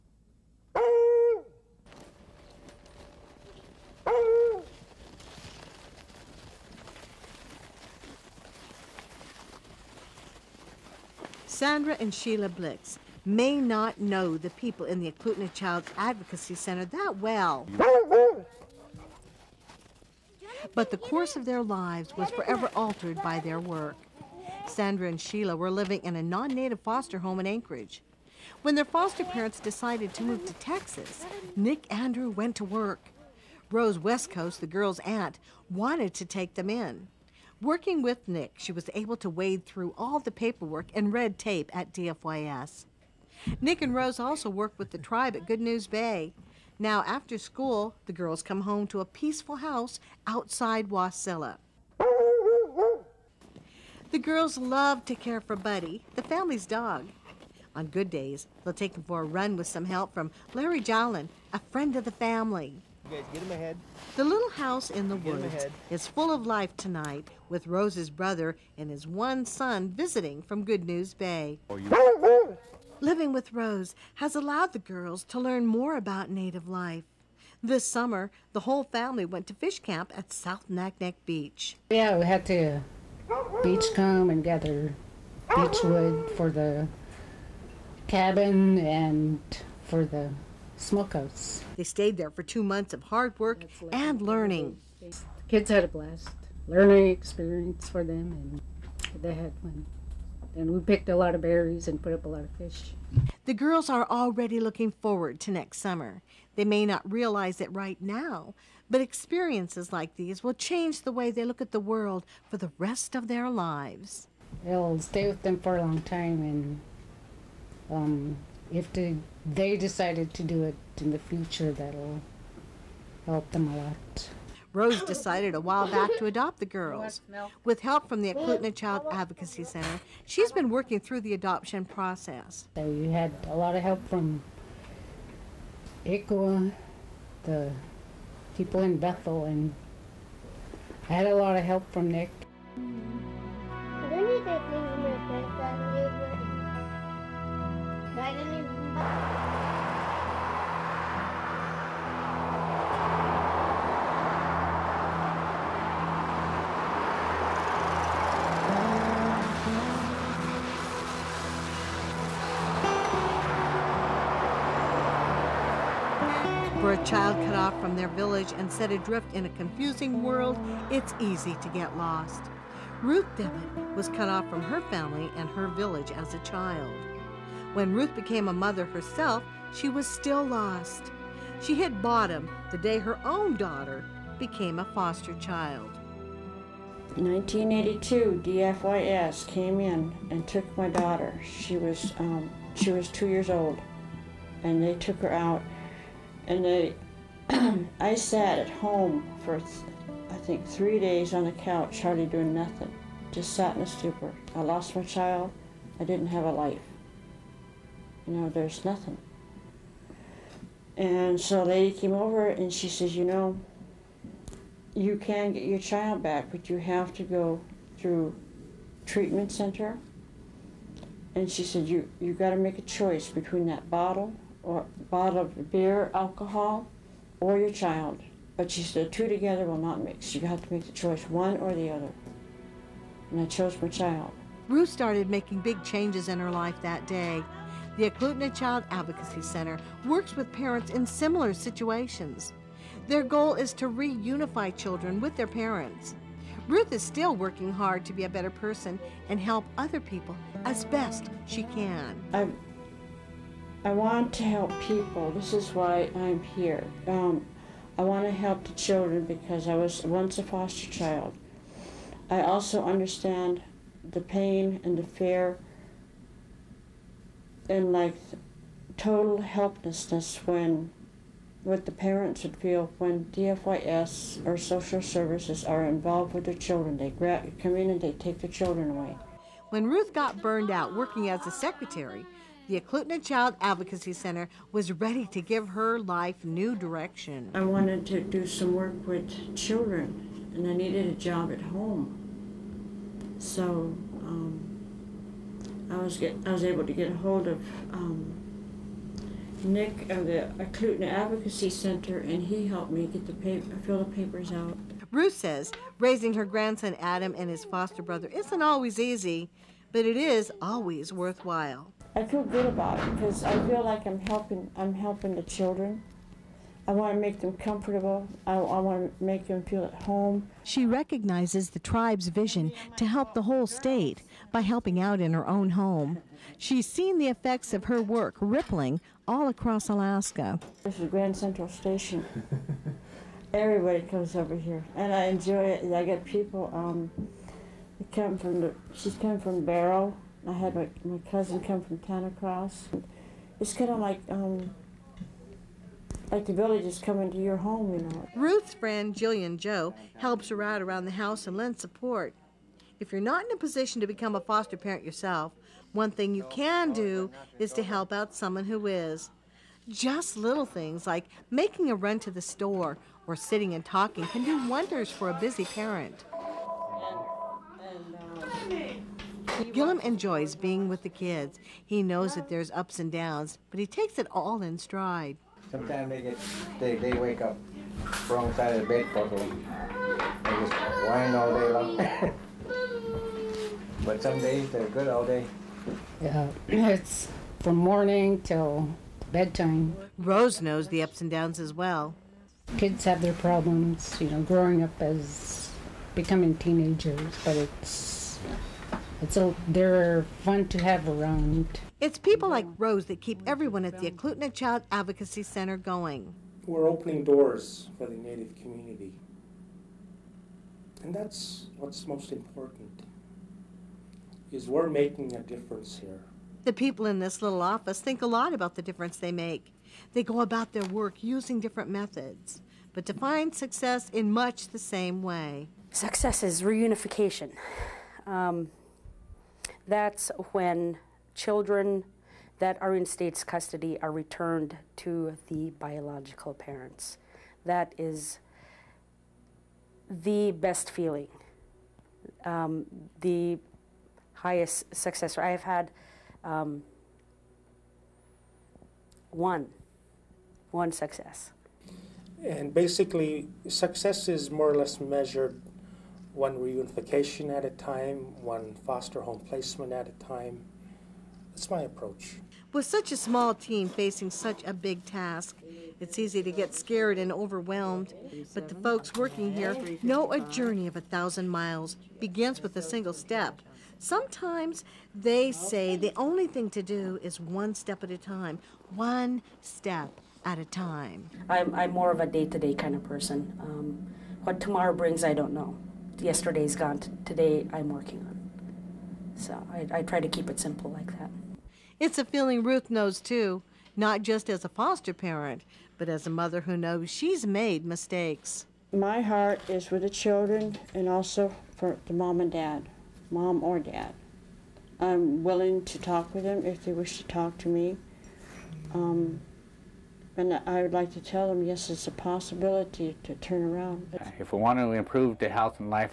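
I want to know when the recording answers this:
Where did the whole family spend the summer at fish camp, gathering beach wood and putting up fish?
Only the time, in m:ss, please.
1:20.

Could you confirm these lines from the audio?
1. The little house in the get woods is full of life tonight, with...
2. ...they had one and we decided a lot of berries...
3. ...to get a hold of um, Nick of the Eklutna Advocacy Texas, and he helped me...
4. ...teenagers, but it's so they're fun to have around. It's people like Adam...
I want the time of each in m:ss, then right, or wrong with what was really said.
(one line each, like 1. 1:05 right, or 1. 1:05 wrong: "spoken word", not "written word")
1. 1:04 right
2. 1:39 wrong: "picked", not "decided"
3. 4:56 wrong: "Center", not "Texas"
4. 6:36 wrong: "Rose", not "Adam".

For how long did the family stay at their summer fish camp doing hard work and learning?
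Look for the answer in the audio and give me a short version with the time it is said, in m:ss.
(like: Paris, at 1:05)
2 months, at 1:32.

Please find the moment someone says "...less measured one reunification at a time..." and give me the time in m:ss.
7:34.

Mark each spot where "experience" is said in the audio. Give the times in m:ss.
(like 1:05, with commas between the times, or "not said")
1:37, 1:49.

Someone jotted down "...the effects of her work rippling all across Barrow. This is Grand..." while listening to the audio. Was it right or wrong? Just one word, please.
wrong.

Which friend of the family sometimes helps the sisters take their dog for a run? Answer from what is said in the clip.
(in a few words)
Larry Jolin.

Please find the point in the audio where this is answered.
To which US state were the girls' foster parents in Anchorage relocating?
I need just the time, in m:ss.
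0:30.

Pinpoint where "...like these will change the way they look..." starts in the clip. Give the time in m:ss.
1:49.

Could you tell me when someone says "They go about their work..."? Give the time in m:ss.
7:00.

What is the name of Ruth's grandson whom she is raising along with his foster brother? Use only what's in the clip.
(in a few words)
Adam.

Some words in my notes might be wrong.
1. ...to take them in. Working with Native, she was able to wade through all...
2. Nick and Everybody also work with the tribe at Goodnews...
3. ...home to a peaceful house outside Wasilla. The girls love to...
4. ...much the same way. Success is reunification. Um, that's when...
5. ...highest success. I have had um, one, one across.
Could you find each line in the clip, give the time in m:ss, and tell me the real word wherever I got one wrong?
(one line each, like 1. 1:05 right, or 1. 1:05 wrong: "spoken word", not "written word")
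1. 0:36 wrong: "Nick", not "Native"
2. 0:43 wrong: "Rose", not "Everybody"
3. 0:48 right
4. 7:04 right
5. 7:24 wrong: "success", not "across".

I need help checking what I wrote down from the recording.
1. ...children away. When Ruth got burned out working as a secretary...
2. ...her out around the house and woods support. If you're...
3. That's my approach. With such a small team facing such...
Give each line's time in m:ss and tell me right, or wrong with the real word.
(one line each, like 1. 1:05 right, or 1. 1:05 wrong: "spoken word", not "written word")
1. 4:38 right
2. 5:50 wrong: "lends", not "woods"
3. 7:41 right.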